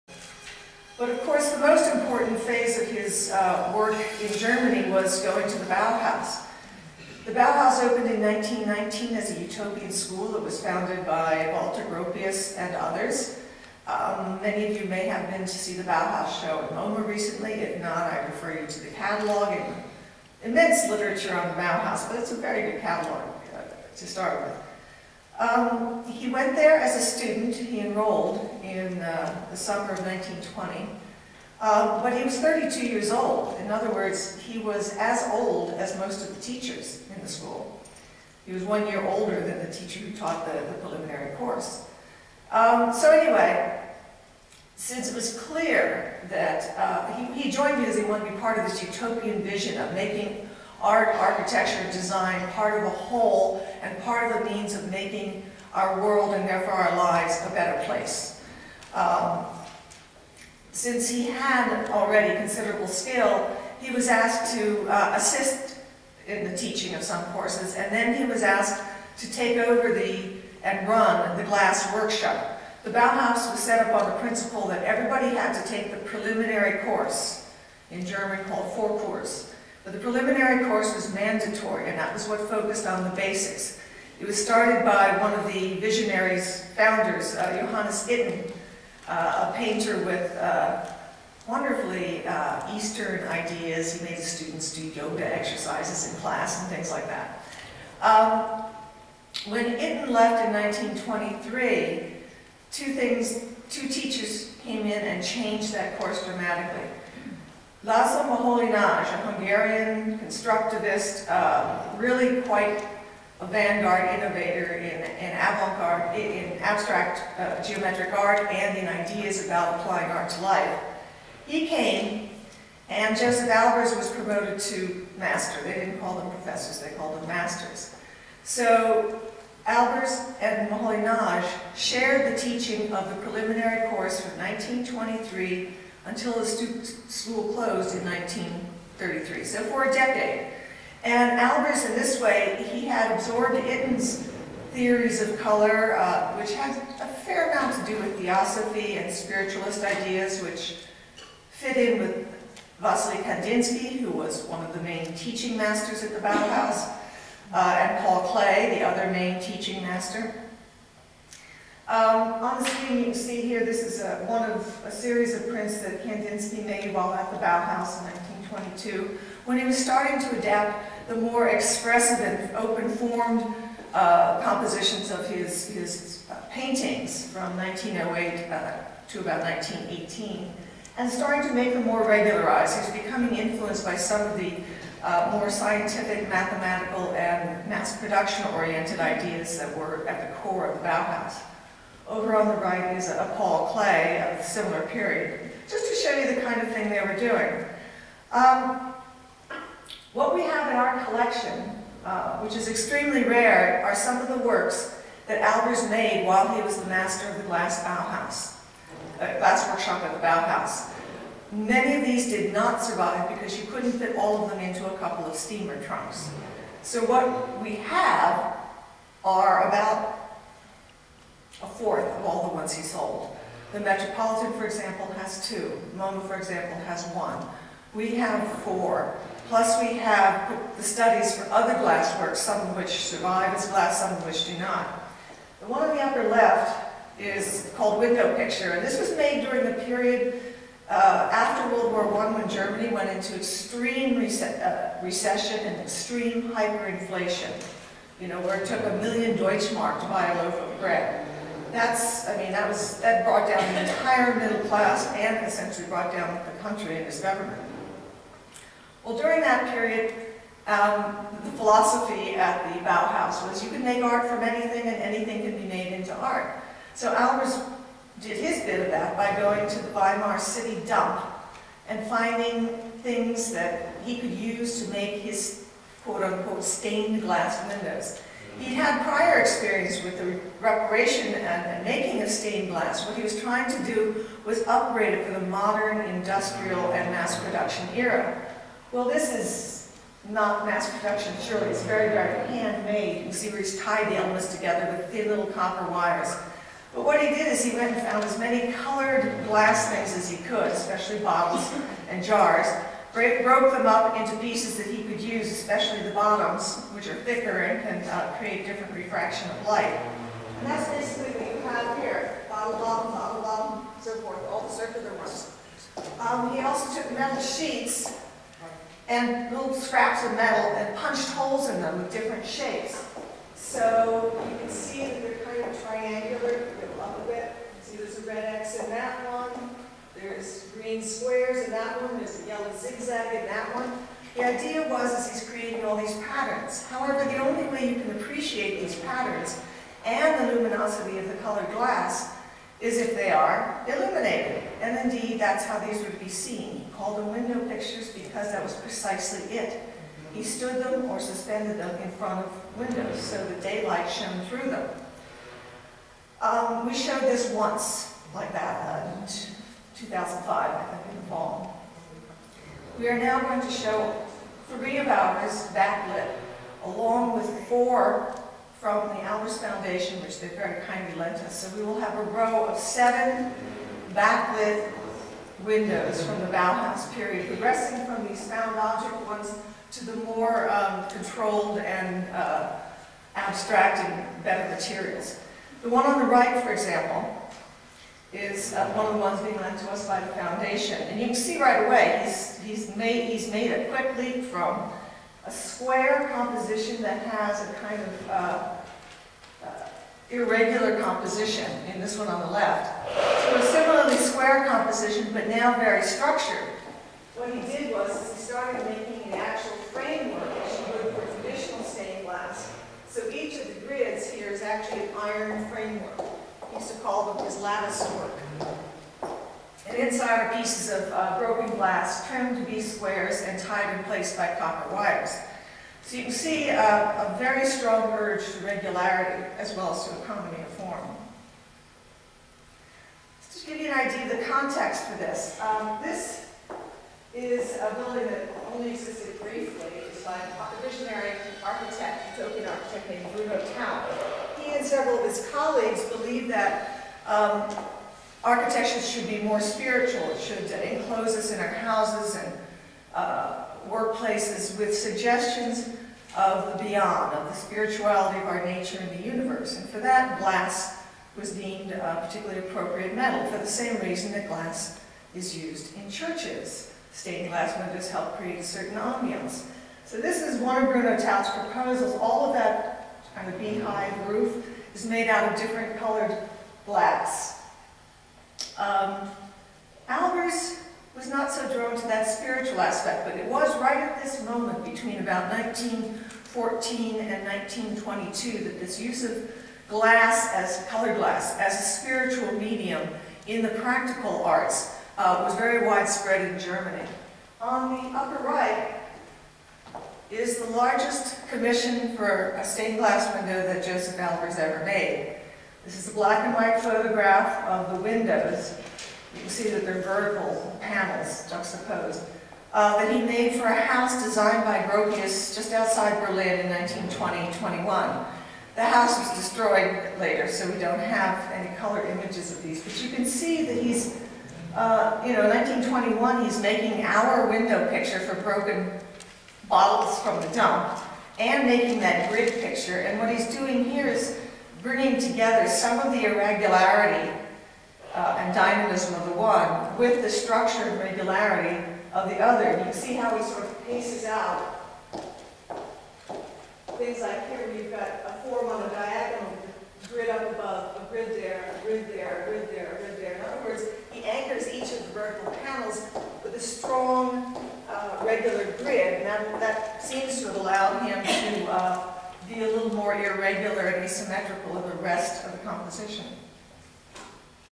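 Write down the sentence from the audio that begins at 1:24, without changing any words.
It was started by one of the visionaries, founders, uh, Johannes Itten, uh, a painter with uh, wonderfully uh, Eastern ideas.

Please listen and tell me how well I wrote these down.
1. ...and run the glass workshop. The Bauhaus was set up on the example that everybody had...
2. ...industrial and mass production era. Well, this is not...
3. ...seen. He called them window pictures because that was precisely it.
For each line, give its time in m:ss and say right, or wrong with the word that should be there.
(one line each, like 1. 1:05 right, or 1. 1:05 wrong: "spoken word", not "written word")
1. 1:10 wrong: "principle", not "example"
2. 4:46 right
3. 5:46 right.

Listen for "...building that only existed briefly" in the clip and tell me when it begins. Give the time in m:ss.
7:17.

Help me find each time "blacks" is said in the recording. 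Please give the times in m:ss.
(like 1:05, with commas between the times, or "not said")
7:56, 8:26.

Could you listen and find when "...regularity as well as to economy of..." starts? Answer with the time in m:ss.
7:08.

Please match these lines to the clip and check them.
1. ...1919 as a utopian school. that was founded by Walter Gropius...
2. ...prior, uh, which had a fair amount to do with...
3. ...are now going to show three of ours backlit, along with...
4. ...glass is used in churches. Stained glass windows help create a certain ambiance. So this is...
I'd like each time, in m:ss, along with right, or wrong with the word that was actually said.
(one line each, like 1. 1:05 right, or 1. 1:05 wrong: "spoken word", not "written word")
1. 0:08 right
2. 2:25 wrong: "color", not "prior"
3. 6:03 right
4. 7:44 right.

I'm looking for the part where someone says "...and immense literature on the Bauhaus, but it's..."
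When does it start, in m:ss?
0:19.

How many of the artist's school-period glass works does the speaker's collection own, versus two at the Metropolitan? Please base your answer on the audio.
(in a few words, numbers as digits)
4.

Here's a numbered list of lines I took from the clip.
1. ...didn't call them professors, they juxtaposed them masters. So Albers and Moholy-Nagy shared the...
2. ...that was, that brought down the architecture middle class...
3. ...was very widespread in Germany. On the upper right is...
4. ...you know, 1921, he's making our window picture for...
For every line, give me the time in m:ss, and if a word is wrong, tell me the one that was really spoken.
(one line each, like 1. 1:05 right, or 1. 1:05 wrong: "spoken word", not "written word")
1. 2:05 wrong: "called", not "juxtaposed"
2. 4:12 wrong: "entire", not "architecture"
3. 8:15 right
4. 8:45 right.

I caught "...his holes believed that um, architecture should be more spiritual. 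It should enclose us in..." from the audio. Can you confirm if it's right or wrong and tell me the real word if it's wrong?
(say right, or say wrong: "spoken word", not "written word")
wrong: "colleagues", not "holes".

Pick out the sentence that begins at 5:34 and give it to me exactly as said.
The idea was is he's creating all these patterns.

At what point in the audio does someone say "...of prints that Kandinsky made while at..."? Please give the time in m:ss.
2:45.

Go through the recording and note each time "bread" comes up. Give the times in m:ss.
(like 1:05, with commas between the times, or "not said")
4:10.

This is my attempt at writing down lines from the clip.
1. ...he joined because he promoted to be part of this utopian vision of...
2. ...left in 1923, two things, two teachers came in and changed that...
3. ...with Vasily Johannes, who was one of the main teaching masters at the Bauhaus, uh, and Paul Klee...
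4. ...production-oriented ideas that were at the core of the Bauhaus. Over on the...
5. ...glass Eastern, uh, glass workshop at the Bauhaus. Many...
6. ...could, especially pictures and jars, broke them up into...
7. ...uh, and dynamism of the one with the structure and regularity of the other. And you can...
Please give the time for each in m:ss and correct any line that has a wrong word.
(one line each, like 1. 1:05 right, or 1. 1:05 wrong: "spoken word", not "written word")
1. 0:47 wrong: "wanted", not "promoted"
2. 1:40 right
3. 2:31 wrong: "Kandinsky", not "Johannes"
4. 3:07 right
5. 3:27 wrong: "Bauhaus", not "Eastern"
6. 5:00 wrong: "bottles", not "pictures"
7. 8:58 right.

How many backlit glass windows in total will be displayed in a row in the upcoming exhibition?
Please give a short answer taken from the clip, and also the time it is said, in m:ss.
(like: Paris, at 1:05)
7, at 6:12.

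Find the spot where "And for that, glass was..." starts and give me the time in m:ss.
7:39.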